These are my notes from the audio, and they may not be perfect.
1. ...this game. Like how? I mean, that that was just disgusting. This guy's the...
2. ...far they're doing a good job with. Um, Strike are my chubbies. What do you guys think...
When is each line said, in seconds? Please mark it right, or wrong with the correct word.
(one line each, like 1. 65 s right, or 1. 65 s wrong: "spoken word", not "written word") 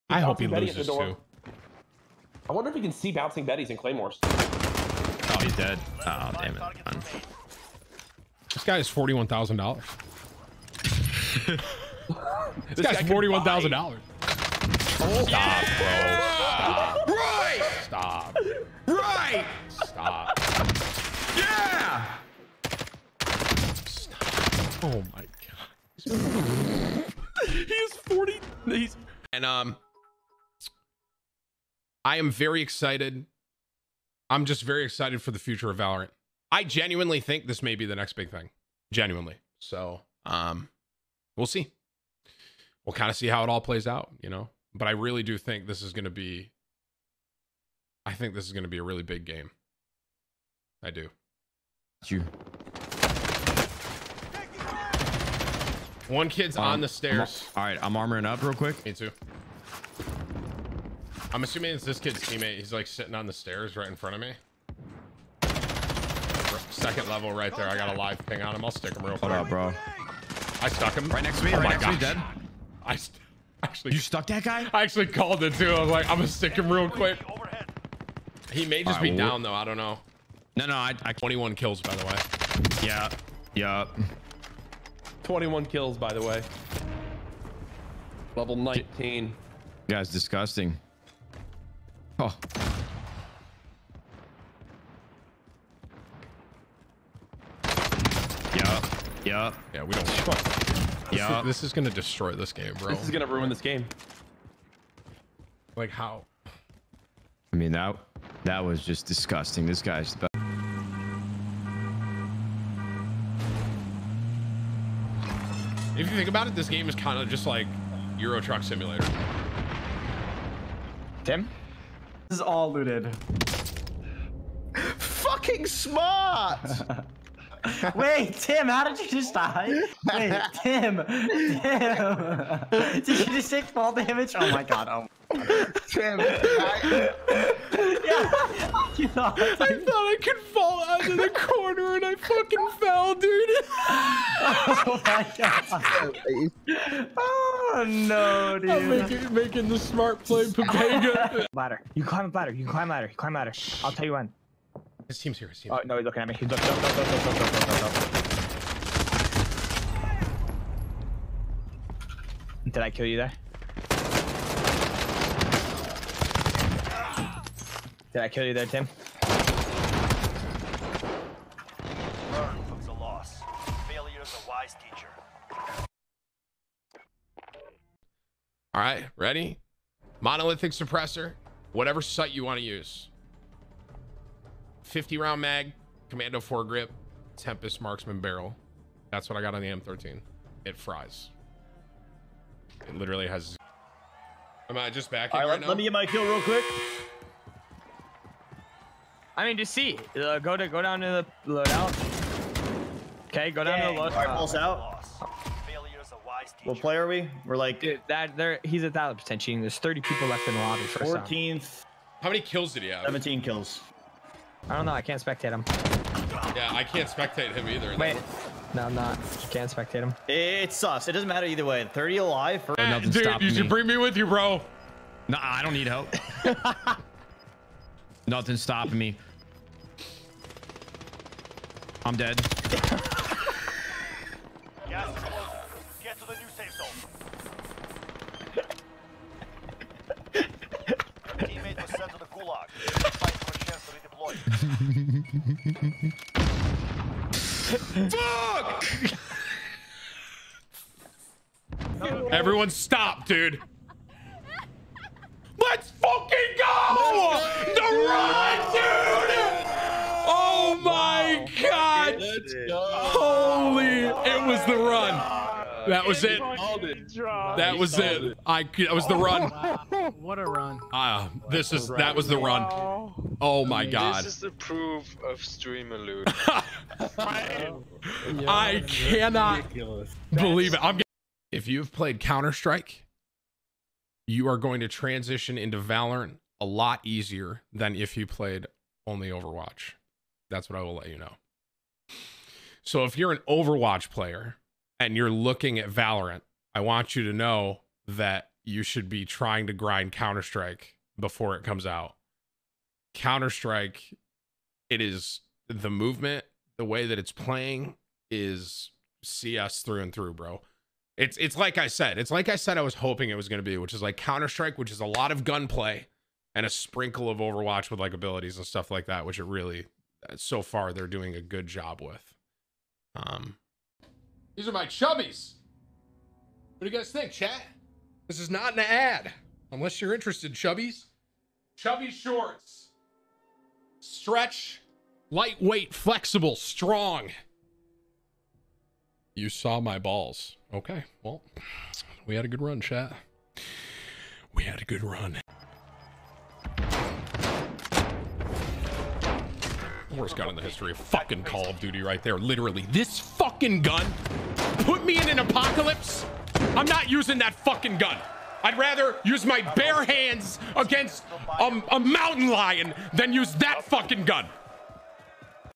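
1. 103 s right
2. 320 s wrong: "These", not "Strike".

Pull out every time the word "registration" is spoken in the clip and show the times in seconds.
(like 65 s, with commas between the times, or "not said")
not said.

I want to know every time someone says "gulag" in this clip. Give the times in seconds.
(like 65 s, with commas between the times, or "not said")
242 s.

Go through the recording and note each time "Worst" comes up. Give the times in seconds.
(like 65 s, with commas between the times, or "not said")
350 s.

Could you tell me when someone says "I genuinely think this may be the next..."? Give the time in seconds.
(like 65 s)
36 s.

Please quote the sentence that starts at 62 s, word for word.
He's like sitting on the stairs right in front of me.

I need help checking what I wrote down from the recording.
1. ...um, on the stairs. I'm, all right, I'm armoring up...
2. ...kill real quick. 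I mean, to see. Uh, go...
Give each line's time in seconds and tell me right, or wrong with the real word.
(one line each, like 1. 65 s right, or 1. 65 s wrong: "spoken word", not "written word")
1. 56 s right
2. 196 s right.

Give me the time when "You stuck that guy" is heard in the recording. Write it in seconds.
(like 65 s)
73 s.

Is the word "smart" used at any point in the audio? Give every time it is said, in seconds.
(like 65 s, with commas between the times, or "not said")
125 s, 149 s.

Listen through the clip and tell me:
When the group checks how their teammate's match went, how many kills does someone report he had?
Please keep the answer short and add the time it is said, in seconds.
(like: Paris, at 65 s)
17, at 213 s.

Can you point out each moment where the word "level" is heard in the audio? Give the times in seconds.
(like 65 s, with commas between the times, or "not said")
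67 s, 88 s.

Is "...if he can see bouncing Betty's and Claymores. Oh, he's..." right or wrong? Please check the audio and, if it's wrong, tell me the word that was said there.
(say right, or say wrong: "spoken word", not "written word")
right.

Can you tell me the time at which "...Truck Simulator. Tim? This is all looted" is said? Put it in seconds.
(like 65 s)
118 s.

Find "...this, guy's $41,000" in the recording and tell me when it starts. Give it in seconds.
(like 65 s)
12 s.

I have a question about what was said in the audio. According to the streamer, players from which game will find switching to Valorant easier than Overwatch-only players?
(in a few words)
Counter-Strike.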